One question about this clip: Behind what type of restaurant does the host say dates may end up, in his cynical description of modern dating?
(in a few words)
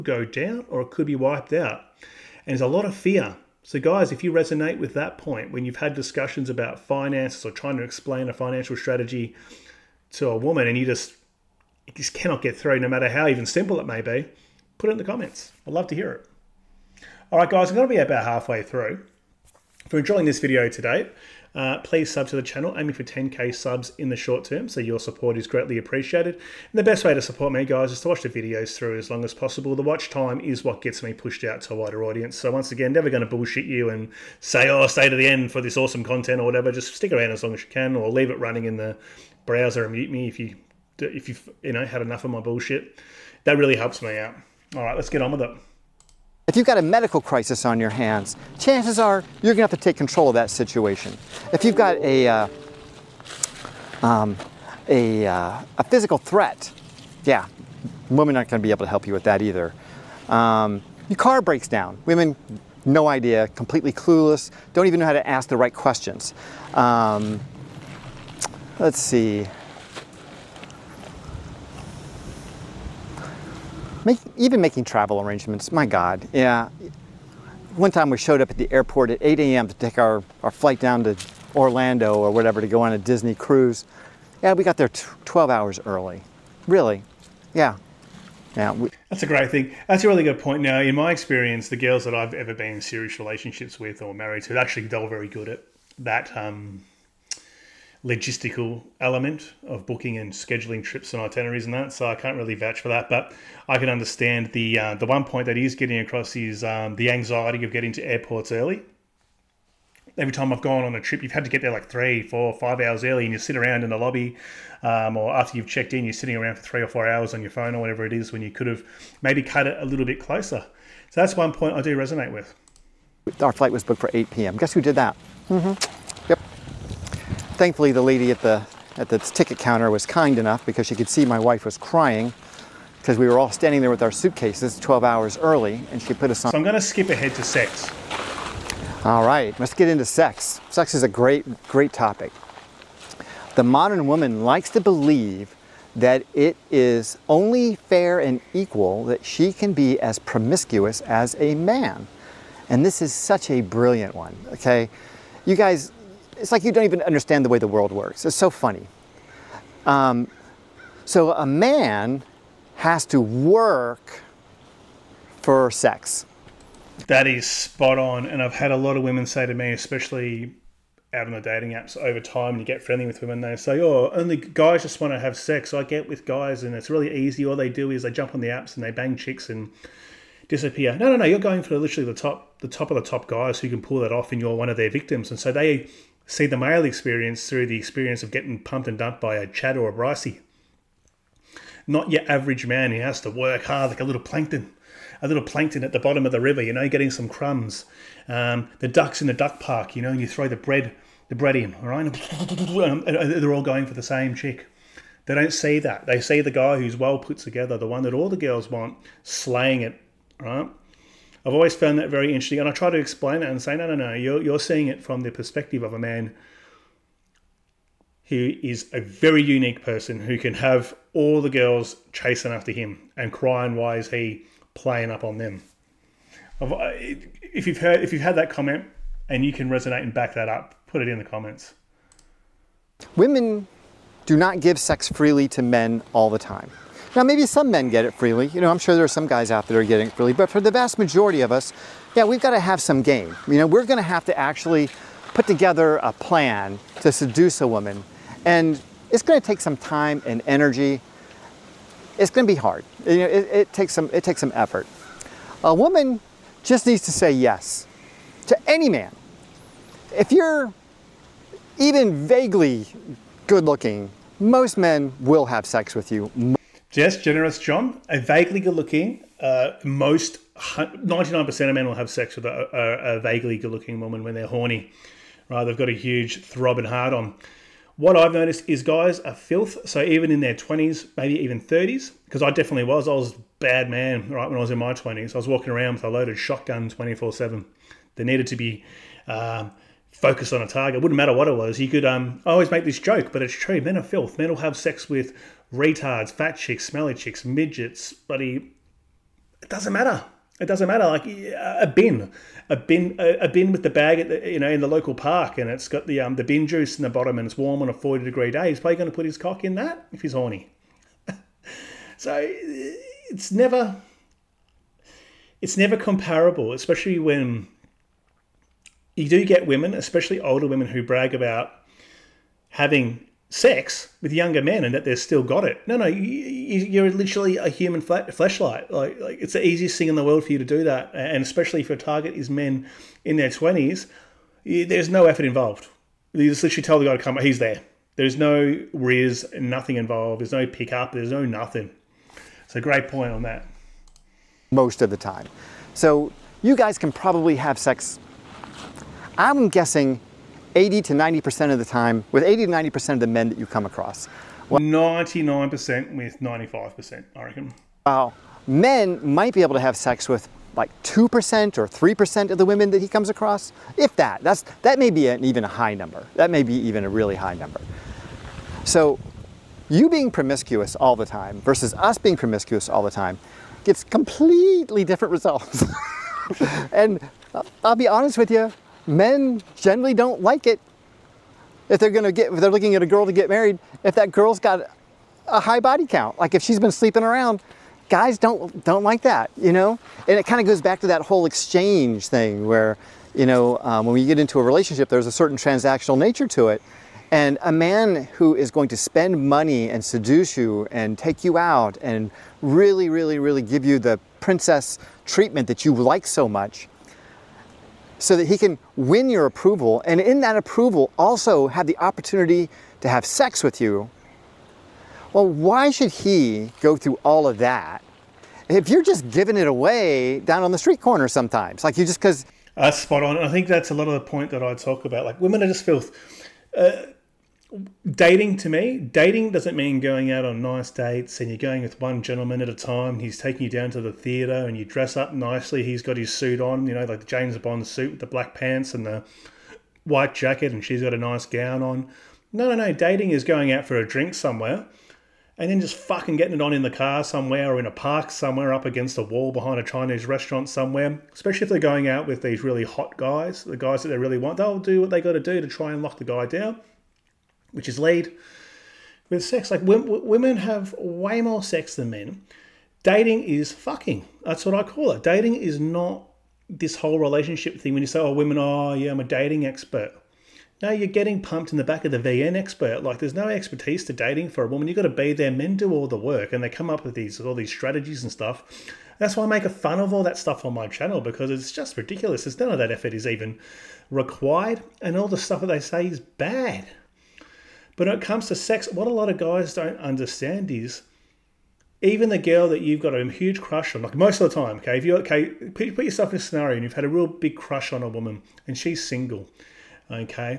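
Chinese restaurant.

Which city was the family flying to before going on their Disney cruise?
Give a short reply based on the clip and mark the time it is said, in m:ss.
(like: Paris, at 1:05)
Orlando, at 1:21.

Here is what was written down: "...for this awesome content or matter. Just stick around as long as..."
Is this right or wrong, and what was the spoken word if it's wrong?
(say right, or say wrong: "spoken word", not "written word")
wrong: "whatever", not "matter".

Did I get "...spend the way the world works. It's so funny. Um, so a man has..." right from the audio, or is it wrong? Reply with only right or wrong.
wrong.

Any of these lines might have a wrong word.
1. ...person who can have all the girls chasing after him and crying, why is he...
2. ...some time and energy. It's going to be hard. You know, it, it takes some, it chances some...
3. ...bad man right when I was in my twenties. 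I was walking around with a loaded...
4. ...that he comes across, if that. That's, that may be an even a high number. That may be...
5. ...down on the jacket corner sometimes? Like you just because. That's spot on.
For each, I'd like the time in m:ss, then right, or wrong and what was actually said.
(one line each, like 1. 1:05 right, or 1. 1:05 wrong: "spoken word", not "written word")
1. 3:39 right
2. 4:09 wrong: "takes", not "chances"
3. 4:43 right
4. 6:02 right
5. 7:00 wrong: "street", not "jacket".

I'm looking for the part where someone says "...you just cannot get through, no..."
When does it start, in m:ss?
0:11.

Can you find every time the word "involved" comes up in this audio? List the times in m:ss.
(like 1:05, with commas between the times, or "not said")
5:35, 5:39.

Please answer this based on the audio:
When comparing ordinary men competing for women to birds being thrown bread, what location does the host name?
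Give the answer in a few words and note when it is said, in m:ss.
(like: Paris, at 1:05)
duck park, at 3:19.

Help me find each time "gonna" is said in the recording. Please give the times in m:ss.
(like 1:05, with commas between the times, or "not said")
0:49, 0:58, 6:22.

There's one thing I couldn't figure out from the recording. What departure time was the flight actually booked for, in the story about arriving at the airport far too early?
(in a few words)
8 p.m.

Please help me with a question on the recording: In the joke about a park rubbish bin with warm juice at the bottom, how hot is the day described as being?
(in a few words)
40 degrees.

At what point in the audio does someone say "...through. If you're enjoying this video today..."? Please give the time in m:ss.
0:18.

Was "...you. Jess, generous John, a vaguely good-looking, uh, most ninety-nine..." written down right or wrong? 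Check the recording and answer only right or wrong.
right.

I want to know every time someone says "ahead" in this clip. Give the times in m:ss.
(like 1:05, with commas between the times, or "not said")
2:17.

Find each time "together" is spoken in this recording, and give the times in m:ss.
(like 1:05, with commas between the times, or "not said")
3:27, 4:05.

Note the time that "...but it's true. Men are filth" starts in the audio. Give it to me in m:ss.
4:53.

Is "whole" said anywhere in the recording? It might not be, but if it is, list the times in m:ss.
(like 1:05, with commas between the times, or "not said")
6:31, 7:46.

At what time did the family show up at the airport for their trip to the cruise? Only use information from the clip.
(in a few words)
8 a.m.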